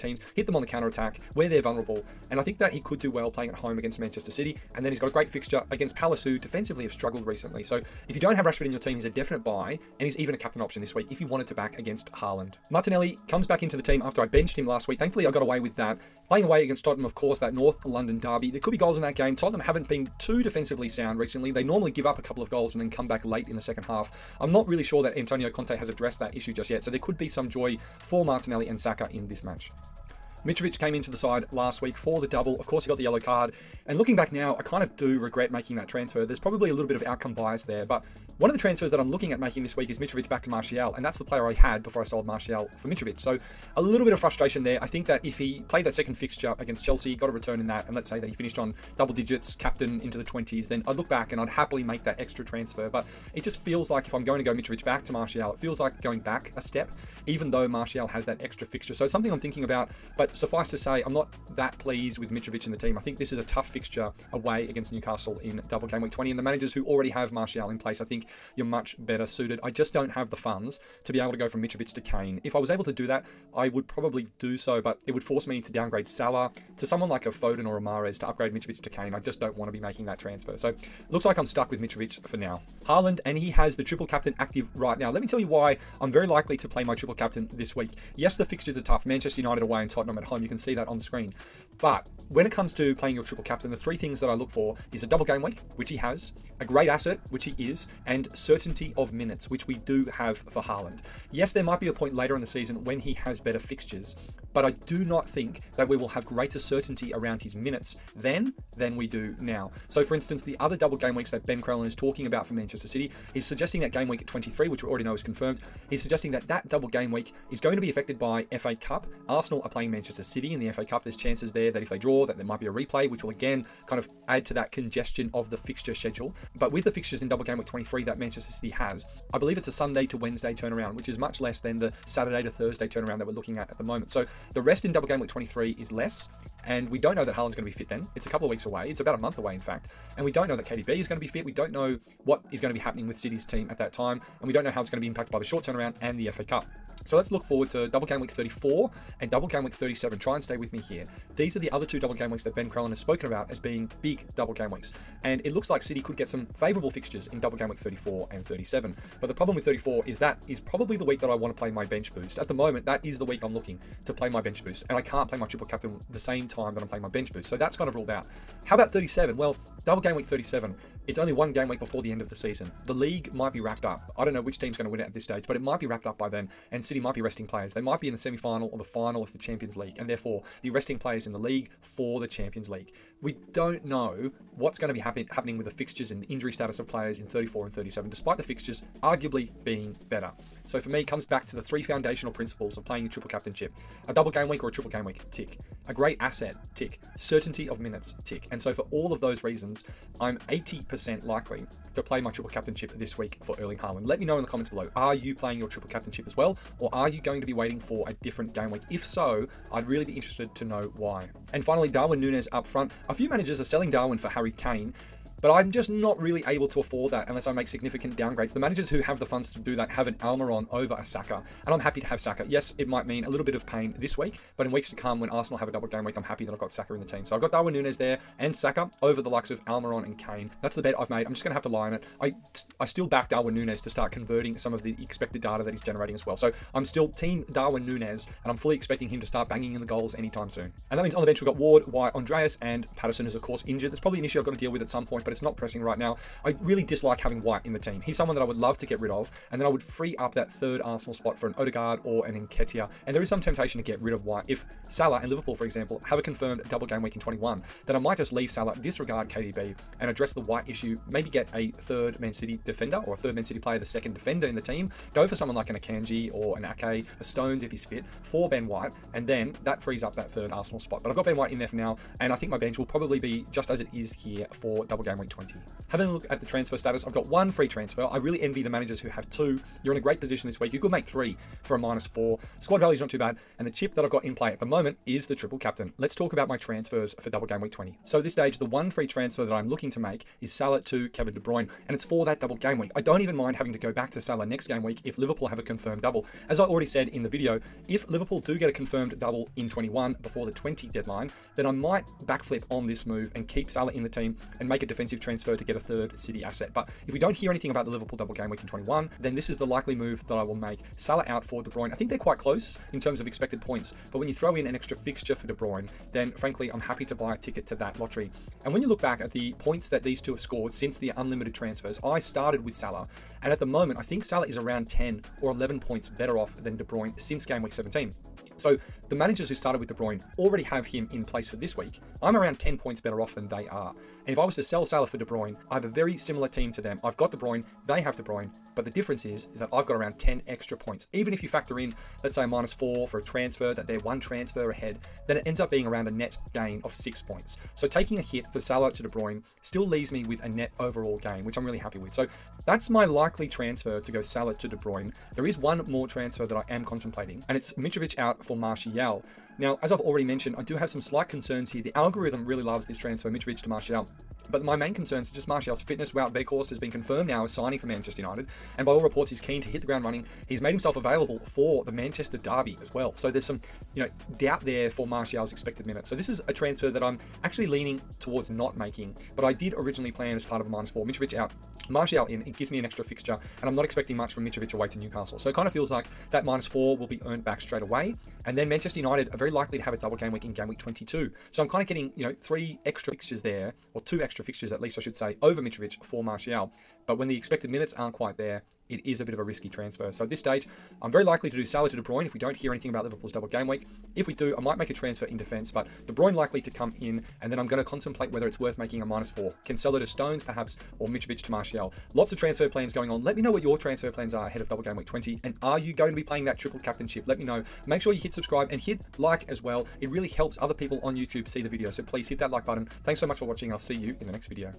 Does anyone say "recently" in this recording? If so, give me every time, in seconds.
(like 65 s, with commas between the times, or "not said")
7 s, 21 s.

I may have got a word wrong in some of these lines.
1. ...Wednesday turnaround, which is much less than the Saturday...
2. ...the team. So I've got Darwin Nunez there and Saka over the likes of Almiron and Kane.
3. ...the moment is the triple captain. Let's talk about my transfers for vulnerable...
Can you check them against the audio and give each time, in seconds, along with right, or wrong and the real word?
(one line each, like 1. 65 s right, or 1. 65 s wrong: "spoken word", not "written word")
1. 130 s right
2. 226 s right
3. 284 s wrong: "double", not "vulnerable".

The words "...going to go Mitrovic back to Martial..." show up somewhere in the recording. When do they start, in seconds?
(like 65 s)
54 s.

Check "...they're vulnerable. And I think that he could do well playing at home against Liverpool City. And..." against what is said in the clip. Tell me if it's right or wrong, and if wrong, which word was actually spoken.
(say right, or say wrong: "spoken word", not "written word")
wrong: "Manchester", not "Liverpool".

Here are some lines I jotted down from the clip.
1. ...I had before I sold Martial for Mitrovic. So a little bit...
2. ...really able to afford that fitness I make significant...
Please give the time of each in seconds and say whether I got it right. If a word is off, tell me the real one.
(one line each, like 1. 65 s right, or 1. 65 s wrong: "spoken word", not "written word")
1. 41 s right
2. 216 s wrong: "unless", not "fitness".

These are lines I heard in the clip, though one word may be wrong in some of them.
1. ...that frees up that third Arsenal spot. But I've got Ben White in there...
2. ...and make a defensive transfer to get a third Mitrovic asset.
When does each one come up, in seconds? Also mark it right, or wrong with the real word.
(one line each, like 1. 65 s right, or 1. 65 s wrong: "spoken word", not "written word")
1. 269 s right
2. 304 s wrong: "City", not "Mitrovic".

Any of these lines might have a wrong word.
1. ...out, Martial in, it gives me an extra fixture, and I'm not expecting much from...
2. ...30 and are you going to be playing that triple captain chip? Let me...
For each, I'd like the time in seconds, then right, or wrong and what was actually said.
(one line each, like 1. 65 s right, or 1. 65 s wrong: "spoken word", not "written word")
1. 381 s right
2. 415 s wrong: "20", not "30".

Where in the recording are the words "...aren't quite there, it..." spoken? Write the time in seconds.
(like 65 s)
397 s.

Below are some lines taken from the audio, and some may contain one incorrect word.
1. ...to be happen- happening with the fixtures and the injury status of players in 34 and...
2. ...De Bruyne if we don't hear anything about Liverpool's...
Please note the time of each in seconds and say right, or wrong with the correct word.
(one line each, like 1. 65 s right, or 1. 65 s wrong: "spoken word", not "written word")
1. 184 s right
2. 401 s right.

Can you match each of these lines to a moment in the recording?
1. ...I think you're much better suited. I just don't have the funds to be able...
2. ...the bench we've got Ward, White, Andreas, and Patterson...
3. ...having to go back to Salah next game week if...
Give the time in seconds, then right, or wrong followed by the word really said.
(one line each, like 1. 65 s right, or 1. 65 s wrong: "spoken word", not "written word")
1. 67 s right
2. 241 s right
3. 293 s right.